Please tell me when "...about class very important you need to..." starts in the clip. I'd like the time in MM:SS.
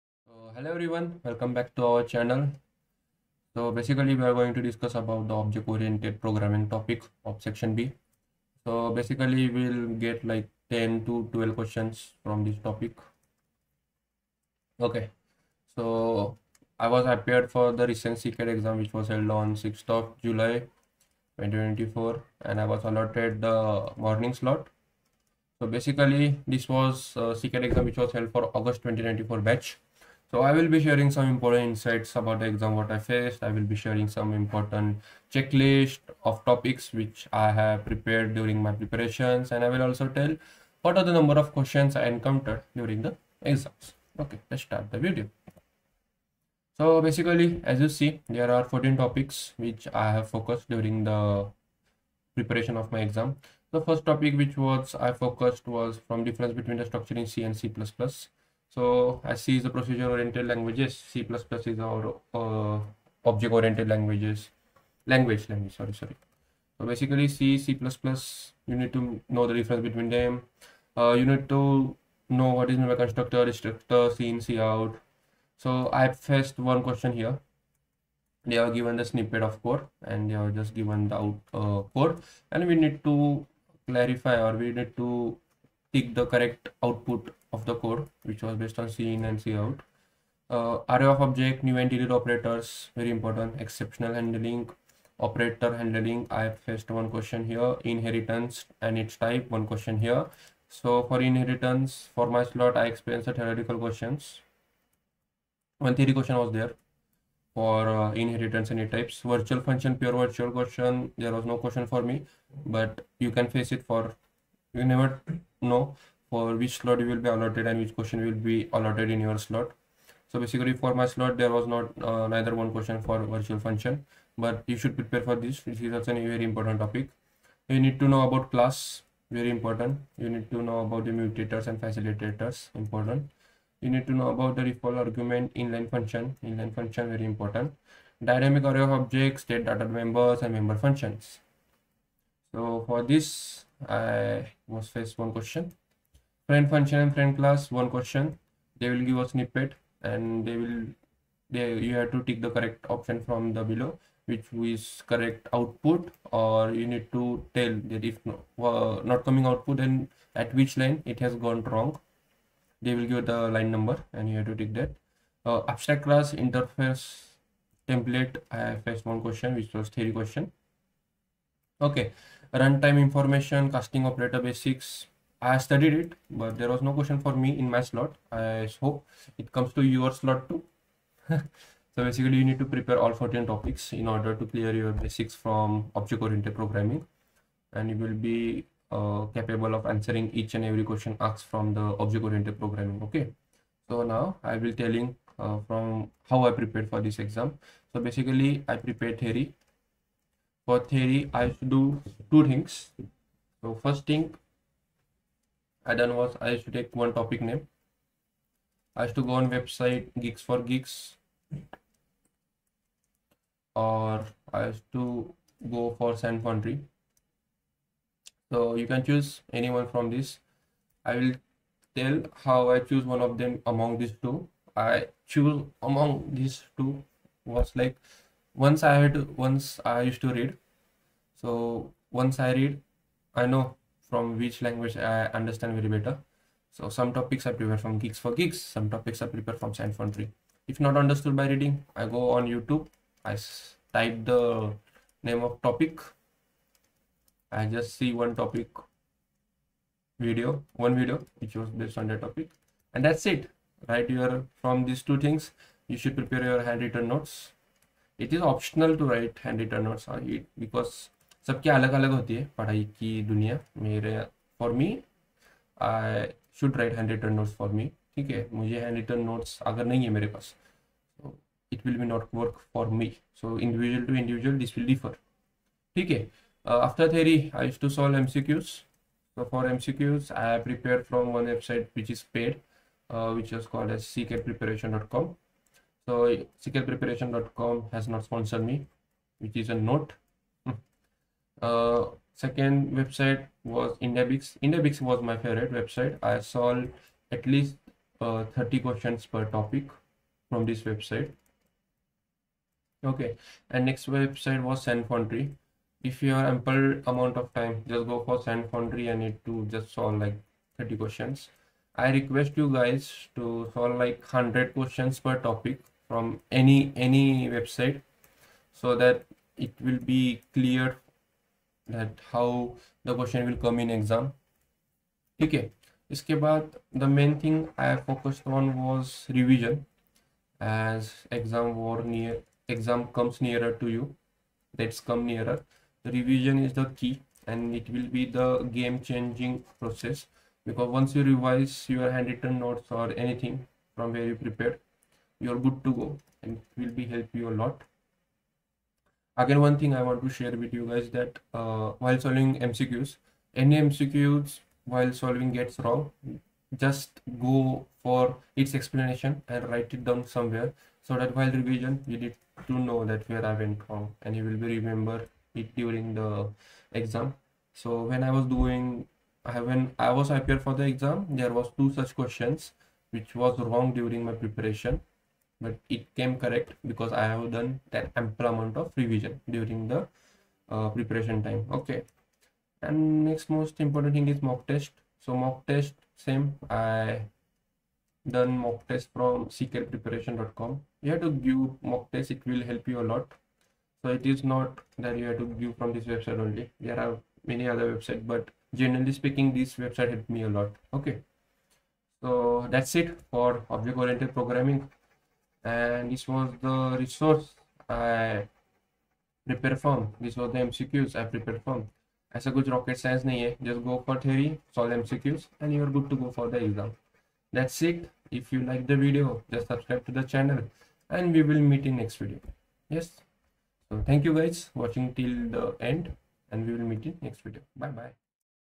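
02:08.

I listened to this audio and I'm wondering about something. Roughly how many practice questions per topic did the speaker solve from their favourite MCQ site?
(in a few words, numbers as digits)
30.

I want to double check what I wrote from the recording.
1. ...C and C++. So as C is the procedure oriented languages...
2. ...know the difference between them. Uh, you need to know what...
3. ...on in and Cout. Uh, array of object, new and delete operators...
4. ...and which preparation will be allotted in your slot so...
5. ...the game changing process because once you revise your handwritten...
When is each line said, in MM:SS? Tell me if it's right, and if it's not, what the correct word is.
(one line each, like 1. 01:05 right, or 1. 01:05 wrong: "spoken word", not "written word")
1. 00:57 right
2. 01:09 right
3. 01:28 right
4. 01:57 wrong: "question", not "preparation"
5. 05:38 right.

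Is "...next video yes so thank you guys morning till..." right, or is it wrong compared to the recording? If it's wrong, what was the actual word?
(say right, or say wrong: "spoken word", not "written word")
wrong: "watching", not "morning".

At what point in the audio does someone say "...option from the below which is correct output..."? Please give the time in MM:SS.
02:32.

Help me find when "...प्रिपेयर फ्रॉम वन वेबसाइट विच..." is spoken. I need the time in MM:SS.
04:40.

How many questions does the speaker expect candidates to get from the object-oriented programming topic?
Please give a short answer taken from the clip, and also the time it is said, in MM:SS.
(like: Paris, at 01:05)
10 to 12, at 00:10.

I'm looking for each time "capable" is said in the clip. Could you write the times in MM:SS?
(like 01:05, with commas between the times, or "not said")
03:09.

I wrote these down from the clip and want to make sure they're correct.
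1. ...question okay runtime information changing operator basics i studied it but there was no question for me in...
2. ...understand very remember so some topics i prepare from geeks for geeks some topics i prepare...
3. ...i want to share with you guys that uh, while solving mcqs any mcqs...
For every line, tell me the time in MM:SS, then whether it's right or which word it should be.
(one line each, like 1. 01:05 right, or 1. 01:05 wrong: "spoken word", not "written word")
1. 02:50 wrong: "casting", not "changing"
2. 03:55 wrong: "better", not "remember"
3. 05:50 right.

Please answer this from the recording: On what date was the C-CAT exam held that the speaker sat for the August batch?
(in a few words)
6th of July 2024.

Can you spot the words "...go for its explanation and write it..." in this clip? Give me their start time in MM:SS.
05:57.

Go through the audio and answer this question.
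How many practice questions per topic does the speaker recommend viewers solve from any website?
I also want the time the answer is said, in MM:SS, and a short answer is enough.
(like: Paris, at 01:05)
100, at 05:14.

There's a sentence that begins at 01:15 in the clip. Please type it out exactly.
So I have faced one question here.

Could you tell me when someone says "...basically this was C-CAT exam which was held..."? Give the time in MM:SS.
00:25.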